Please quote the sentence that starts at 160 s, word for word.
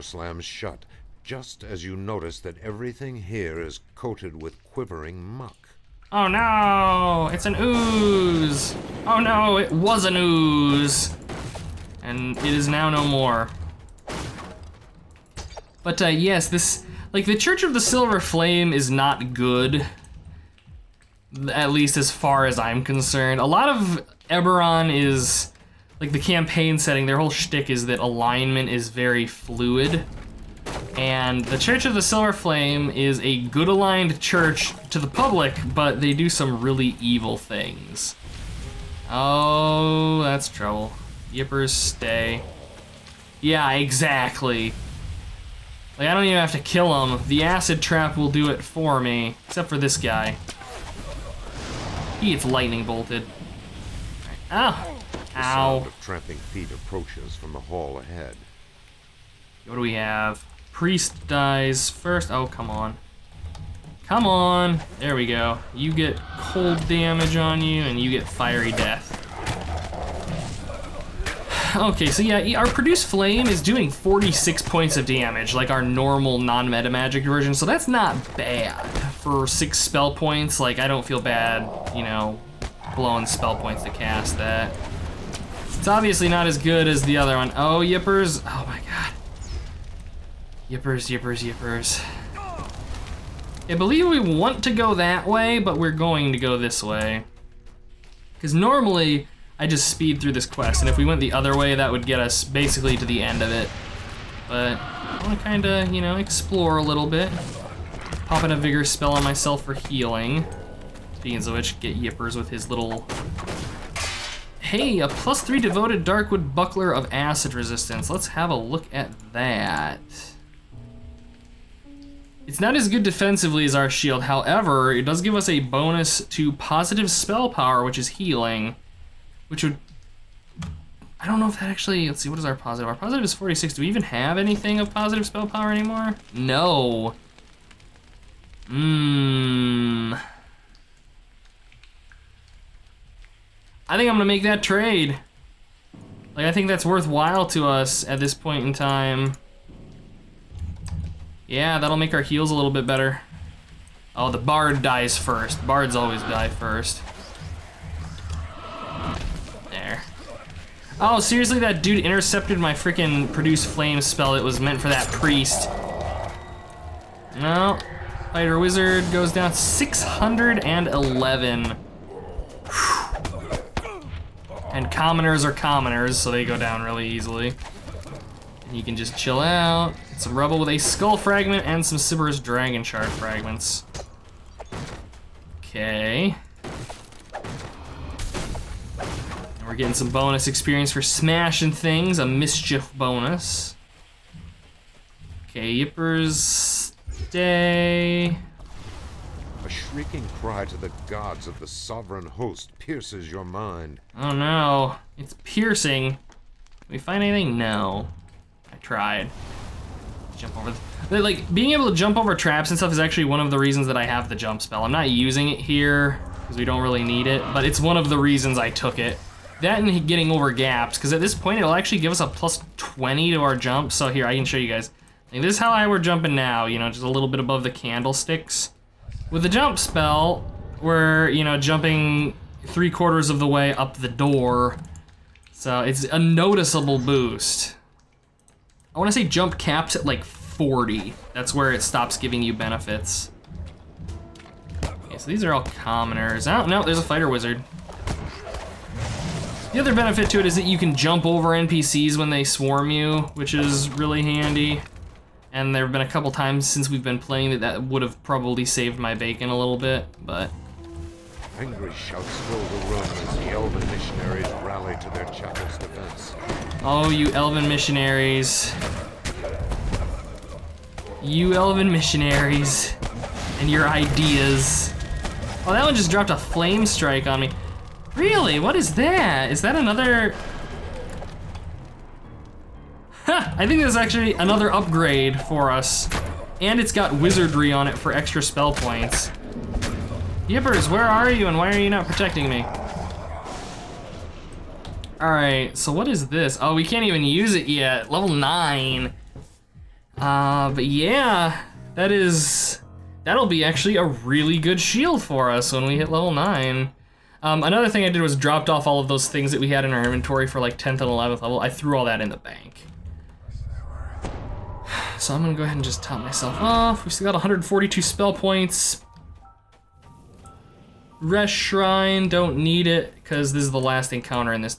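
Oh, seriously, that dude intercepted my freaking produce flame spell.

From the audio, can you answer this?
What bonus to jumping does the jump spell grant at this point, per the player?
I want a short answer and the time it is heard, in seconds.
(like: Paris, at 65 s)
+20, at 222 s.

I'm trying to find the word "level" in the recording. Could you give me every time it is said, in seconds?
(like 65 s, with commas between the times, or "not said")
298 s, 306 s, 311 s.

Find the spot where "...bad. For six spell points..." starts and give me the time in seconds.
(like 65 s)
78 s.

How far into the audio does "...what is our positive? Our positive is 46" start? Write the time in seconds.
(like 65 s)
132 s.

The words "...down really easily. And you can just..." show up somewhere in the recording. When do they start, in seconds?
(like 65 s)
176 s.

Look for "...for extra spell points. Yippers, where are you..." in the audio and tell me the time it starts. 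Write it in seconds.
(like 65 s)
287 s.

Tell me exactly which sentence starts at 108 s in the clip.
Pop in a vigor spell on myself for healing.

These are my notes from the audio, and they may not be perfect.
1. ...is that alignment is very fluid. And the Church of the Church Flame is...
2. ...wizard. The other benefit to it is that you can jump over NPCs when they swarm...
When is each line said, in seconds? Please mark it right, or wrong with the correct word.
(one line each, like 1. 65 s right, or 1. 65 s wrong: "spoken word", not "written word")
1. 27 s wrong: "Silver", not "Church"
2. 247 s right.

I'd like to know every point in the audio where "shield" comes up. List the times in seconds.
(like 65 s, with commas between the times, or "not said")
123 s, 304 s.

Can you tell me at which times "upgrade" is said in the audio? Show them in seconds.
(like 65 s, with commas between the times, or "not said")
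284 s.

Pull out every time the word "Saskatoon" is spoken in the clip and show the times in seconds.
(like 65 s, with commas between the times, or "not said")
not said.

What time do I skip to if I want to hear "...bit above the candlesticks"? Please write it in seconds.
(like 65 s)
227 s.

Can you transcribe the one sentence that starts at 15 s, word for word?
But uh, yes, this, like the Church of the Silver Flame is not good.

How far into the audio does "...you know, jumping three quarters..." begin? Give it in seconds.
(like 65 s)
231 s.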